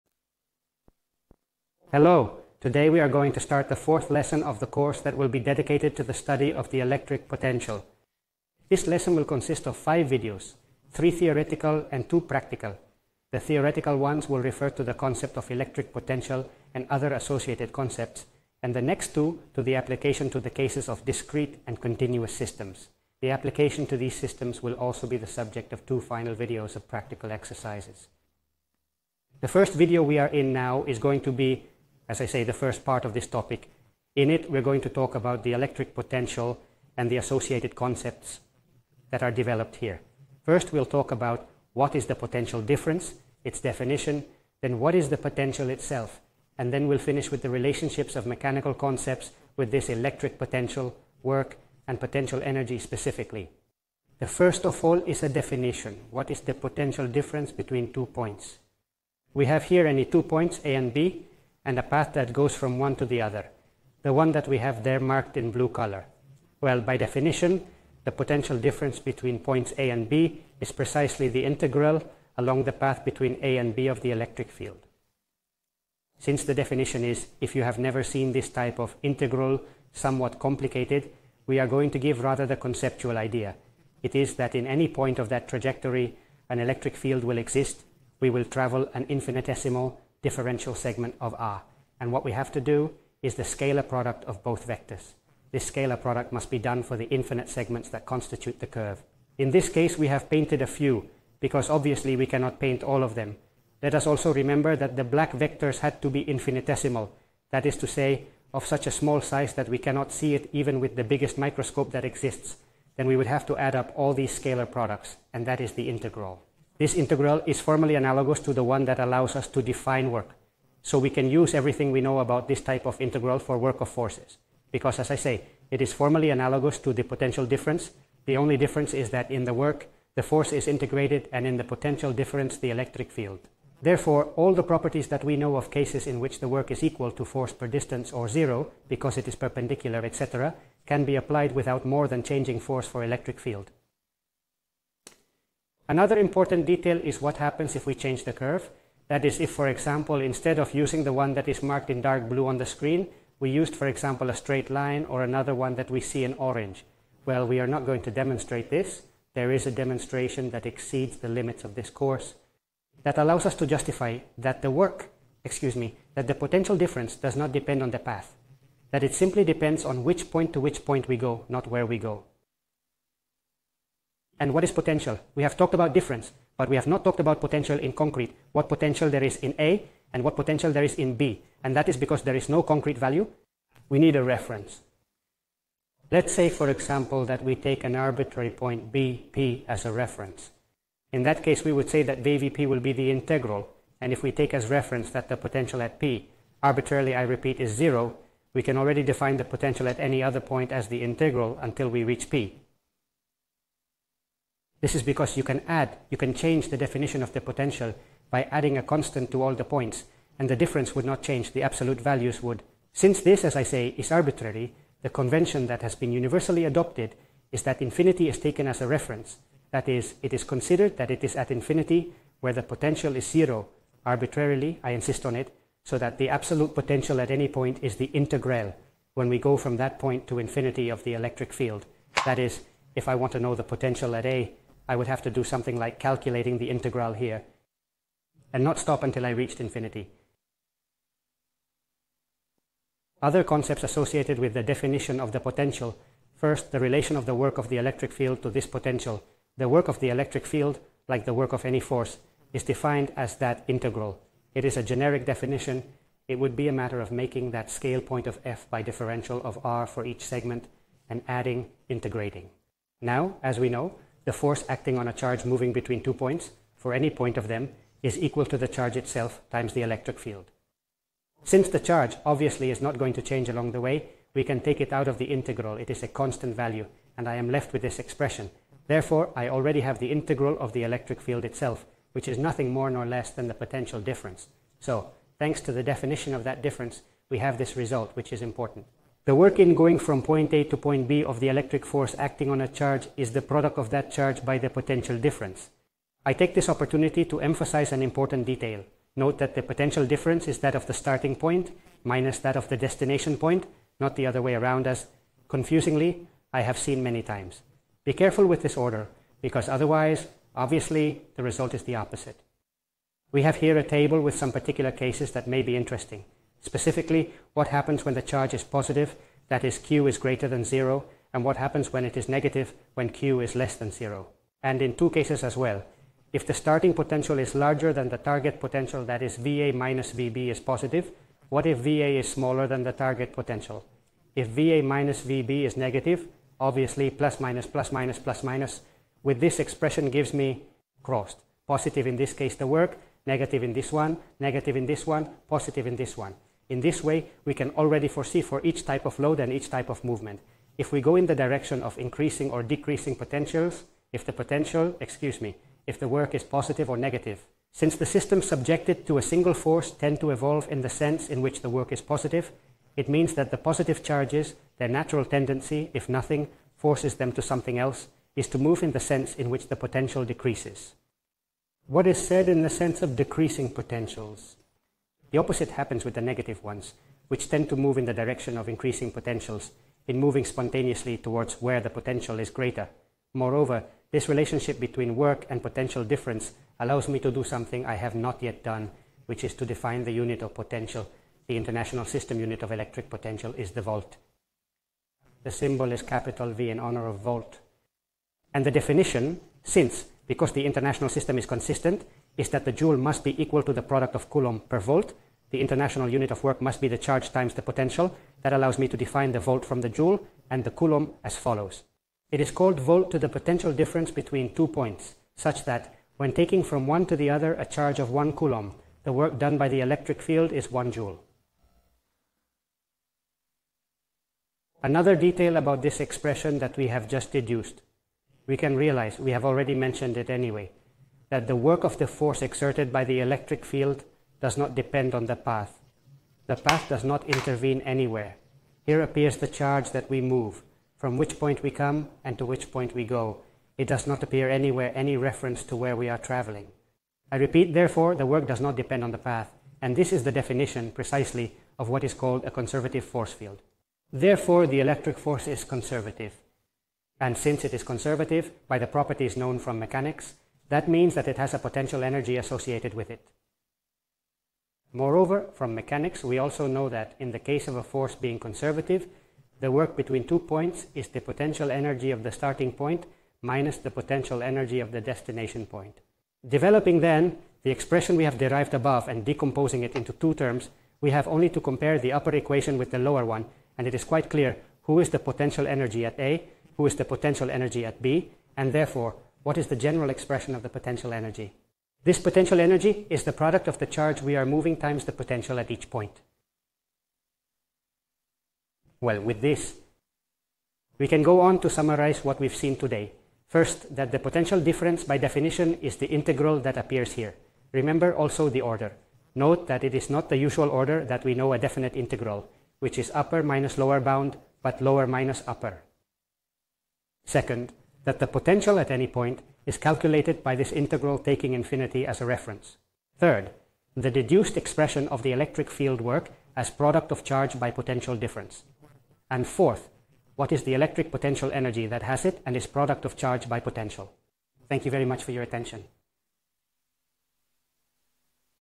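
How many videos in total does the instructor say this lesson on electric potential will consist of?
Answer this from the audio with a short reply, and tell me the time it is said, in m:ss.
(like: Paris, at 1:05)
5, at 0:09.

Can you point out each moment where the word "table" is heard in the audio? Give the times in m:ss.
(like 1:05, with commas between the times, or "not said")
5:13.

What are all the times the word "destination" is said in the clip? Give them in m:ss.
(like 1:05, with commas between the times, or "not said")
5:02, 7:54.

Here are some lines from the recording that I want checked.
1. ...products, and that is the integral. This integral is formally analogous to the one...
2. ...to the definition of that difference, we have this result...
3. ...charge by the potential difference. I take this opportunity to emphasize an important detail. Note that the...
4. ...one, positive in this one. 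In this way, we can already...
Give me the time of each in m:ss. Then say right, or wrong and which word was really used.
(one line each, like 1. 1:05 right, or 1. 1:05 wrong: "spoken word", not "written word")
1. 1:54 right
2. 4:45 right
3. 4:54 right
4. 5:45 right.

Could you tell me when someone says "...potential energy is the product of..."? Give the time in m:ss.
8:12.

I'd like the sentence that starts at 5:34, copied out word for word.
If VA minus VB is negative, obviously plus minus plus minus plus minus, with this expression gives me crossed.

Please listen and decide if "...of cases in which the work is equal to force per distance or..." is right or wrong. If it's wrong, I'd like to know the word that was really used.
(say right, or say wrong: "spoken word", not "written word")
right.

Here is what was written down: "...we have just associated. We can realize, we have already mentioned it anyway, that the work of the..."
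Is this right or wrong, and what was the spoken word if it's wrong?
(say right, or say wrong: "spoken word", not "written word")
wrong: "deduced", not "associated".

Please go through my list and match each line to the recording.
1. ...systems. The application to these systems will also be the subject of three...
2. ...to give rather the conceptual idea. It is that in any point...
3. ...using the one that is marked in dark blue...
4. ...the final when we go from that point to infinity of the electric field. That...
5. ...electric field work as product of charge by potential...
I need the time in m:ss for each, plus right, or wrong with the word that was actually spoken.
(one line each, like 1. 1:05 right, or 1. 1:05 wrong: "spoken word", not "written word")
1. 0:22 wrong: "two", not "three"
2. 1:21 right
3. 2:30 right
4. 3:47 wrong: "integral", not "final"
5. 8:45 right.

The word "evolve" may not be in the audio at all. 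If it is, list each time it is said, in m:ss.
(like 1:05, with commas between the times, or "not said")
6:00.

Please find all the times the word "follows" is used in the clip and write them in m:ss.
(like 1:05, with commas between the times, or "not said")
6:51.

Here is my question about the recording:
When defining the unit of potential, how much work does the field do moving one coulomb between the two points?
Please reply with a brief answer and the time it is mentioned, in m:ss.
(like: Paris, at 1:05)
1 joule, at 7:00.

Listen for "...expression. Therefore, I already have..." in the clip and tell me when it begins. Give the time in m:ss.
4:37.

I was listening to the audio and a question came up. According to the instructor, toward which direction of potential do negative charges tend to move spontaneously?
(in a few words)
Increasing potentials.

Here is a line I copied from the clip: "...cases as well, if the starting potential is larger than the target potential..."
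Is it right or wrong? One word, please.
right.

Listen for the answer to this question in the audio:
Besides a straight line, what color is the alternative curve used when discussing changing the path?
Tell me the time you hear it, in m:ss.
2:36.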